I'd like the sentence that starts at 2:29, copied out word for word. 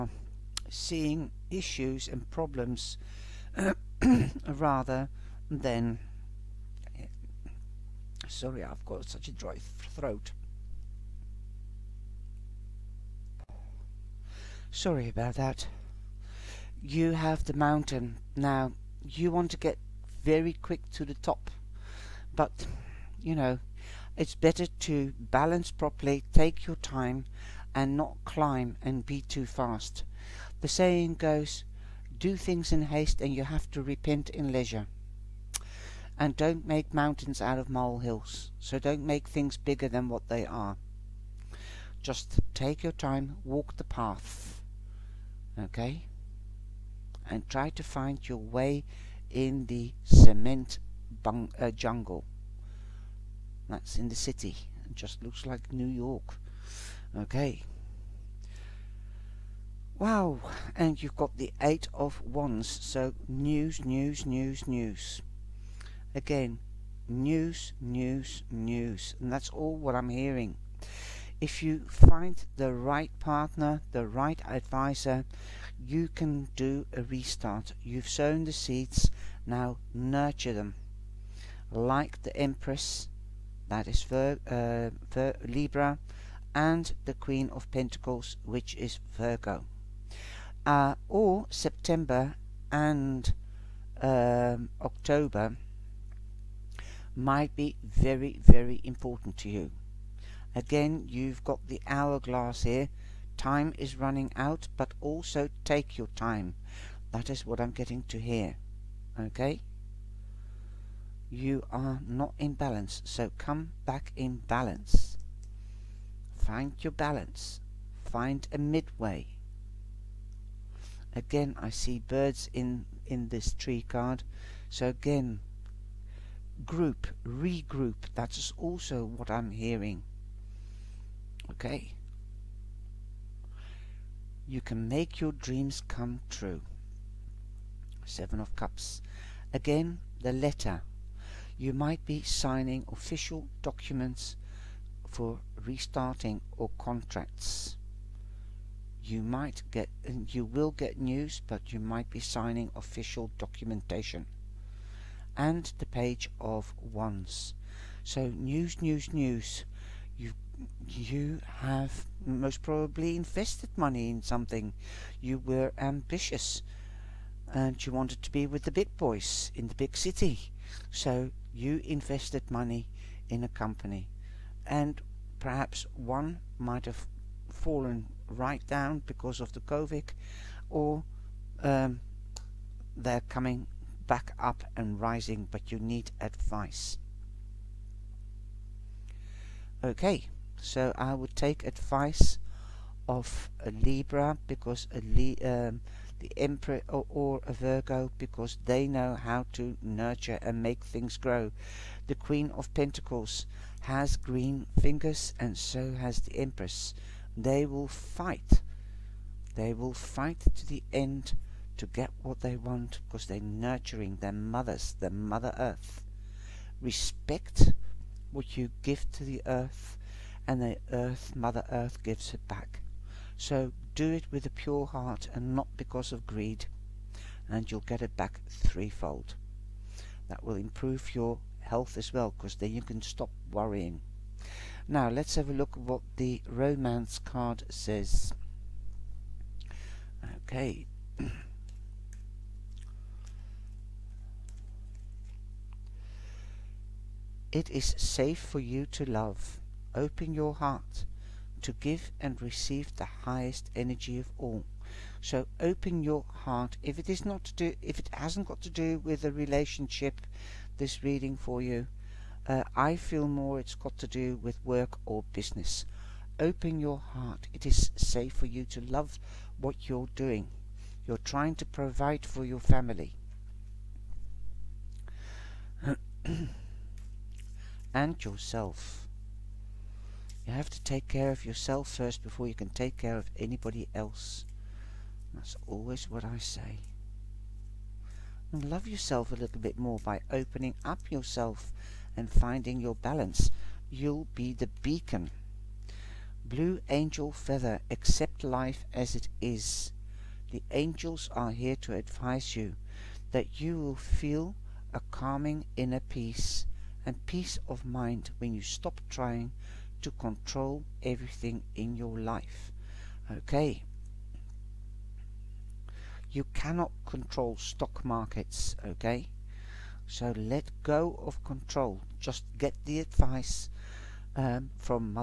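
You might get, you will get news, but you might be signing official documentation and the page of wands.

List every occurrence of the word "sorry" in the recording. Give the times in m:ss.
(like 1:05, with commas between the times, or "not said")
0:08, 0:14.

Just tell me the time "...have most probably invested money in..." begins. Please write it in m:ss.
2:41.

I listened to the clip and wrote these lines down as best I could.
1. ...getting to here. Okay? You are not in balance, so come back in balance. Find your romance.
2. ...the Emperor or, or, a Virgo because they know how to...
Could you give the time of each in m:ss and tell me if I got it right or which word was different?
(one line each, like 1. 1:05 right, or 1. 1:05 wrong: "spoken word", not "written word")
1. 1:47 wrong: "balance", not "romance"
2. 3:16 right.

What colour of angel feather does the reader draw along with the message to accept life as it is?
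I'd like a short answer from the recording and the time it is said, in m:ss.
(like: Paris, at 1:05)
Blue, at 4:56.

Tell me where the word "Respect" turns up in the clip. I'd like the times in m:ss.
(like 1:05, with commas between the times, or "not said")
3:36.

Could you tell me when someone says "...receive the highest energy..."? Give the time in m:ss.
4:12.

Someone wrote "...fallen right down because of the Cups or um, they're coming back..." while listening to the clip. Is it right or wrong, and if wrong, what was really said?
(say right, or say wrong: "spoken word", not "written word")
wrong: "COVID", not "Cups".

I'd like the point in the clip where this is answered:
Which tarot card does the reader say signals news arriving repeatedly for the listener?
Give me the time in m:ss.
1:01.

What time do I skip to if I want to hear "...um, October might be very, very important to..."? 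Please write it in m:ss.
1:34.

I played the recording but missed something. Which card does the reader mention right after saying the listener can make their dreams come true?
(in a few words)
Seven of Cups.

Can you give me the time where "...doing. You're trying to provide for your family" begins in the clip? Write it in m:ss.
4:30.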